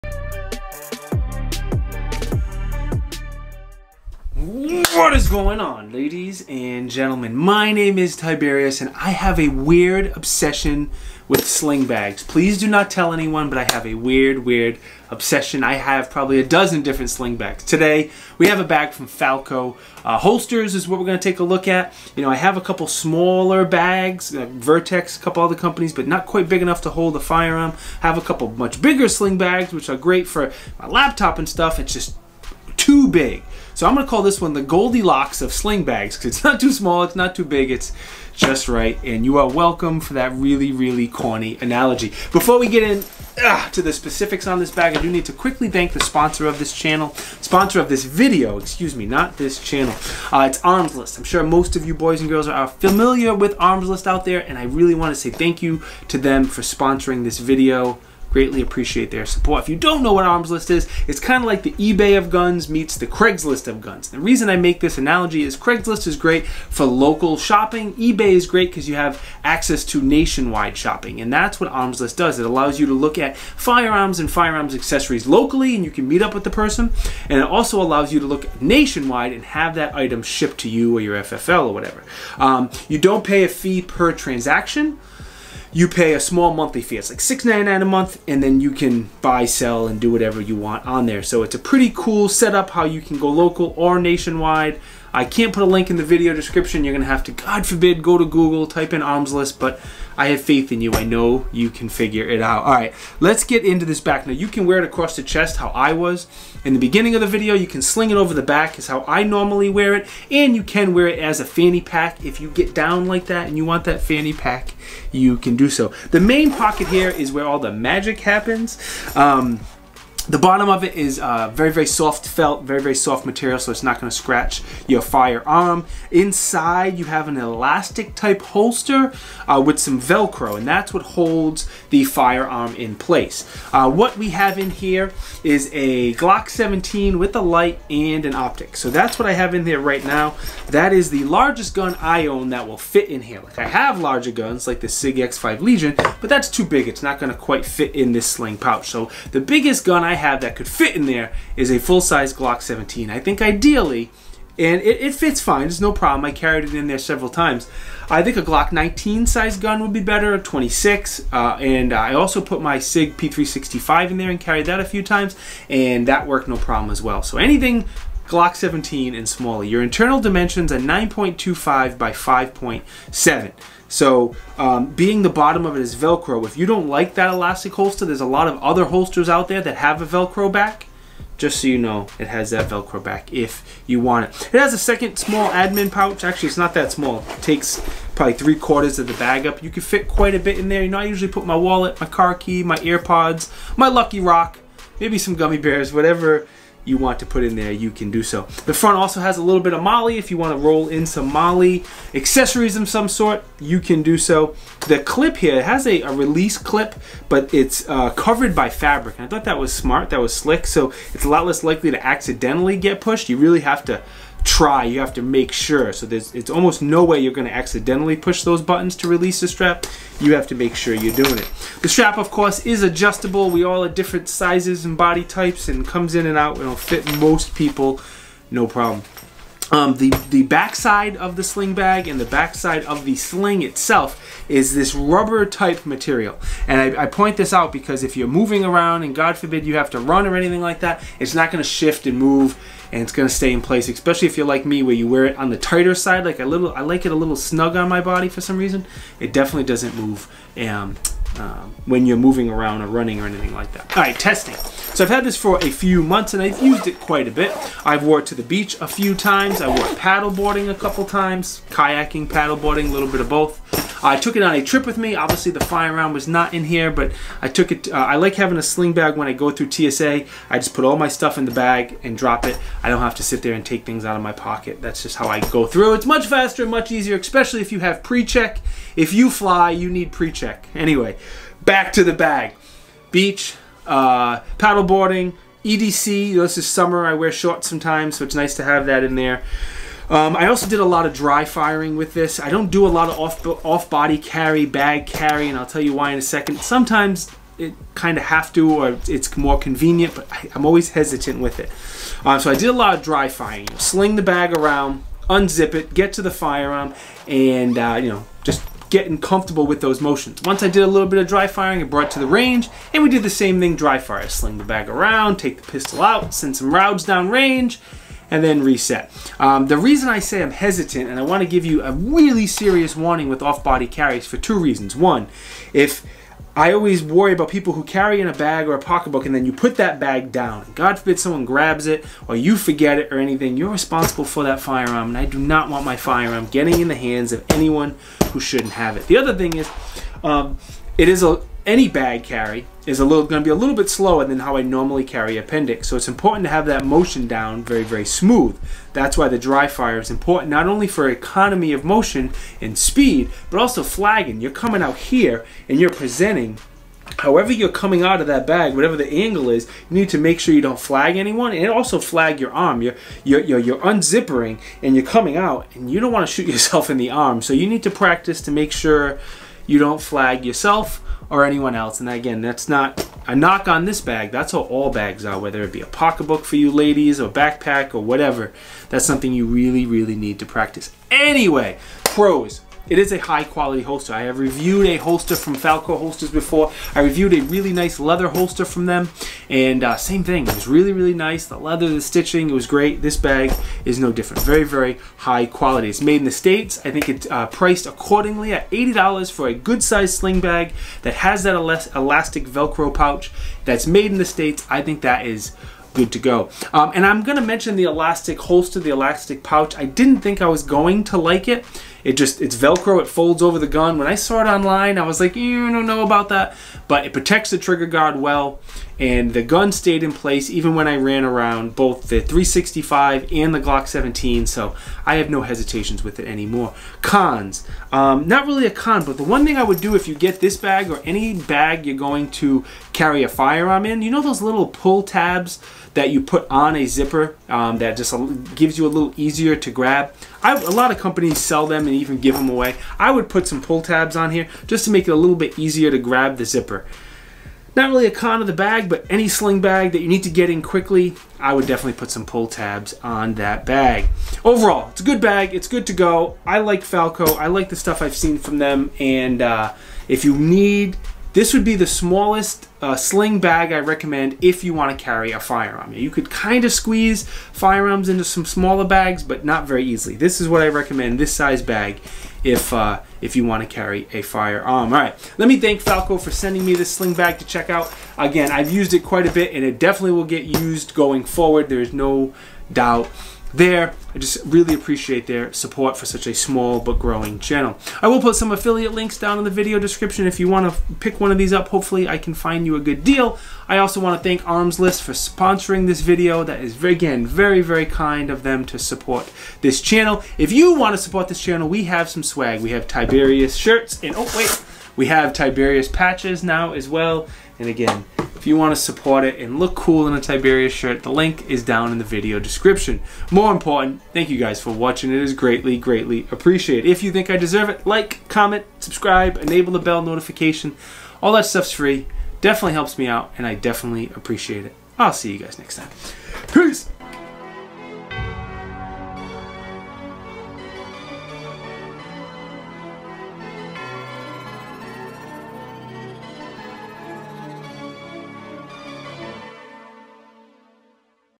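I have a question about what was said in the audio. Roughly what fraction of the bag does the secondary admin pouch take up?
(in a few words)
three quarters.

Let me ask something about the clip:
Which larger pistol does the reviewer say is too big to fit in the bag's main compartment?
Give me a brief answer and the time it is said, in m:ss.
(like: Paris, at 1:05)
SIG X5 Legion, at 2:24.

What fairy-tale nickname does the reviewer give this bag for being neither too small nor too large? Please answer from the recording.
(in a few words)
Goldilocks of sling bags.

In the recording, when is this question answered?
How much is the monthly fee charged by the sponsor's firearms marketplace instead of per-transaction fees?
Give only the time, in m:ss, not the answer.
1:27.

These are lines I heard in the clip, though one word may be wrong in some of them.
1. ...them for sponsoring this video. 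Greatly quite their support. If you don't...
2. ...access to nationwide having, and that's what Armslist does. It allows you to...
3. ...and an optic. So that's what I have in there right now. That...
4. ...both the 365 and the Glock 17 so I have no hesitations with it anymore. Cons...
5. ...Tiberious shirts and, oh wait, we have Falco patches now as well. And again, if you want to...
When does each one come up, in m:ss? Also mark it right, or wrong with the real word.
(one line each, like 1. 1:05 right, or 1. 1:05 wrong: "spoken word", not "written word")
1. 0:56 wrong: "appreciate", not "quite"
2. 1:09 wrong: "shopping", not "having"
3. 2:17 right
4. 7:01 right
5. 8:22 wrong: "Tiberious", not "Falco".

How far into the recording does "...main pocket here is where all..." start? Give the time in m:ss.
1:56.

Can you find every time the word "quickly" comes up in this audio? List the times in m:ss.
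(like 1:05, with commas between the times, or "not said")
0:45, 7:30.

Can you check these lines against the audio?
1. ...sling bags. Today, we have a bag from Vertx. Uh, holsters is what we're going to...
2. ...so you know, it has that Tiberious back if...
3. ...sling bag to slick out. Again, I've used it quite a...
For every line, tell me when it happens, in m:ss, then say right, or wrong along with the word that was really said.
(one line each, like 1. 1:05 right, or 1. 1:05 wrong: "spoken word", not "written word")
1. 0:17 wrong: "Falco", not "Vertx"
2. 3:01 wrong: "Velcro", not "Tiberious"
3. 7:56 wrong: "check", not "slick".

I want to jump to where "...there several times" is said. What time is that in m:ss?
2:36.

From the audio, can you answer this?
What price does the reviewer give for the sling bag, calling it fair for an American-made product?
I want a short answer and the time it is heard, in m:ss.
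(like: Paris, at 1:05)
$80, at 6:38.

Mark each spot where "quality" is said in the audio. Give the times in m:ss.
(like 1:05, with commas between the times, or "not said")
6:23, 6:35.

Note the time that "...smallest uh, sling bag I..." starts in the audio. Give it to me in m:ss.
7:41.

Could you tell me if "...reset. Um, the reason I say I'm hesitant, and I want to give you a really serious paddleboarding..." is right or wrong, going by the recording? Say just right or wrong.
wrong.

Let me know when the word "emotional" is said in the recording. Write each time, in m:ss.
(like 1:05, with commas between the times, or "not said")
not said.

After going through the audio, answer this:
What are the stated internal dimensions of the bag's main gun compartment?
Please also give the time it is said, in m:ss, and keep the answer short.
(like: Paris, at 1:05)
9.25 by 5.7, at 2:50.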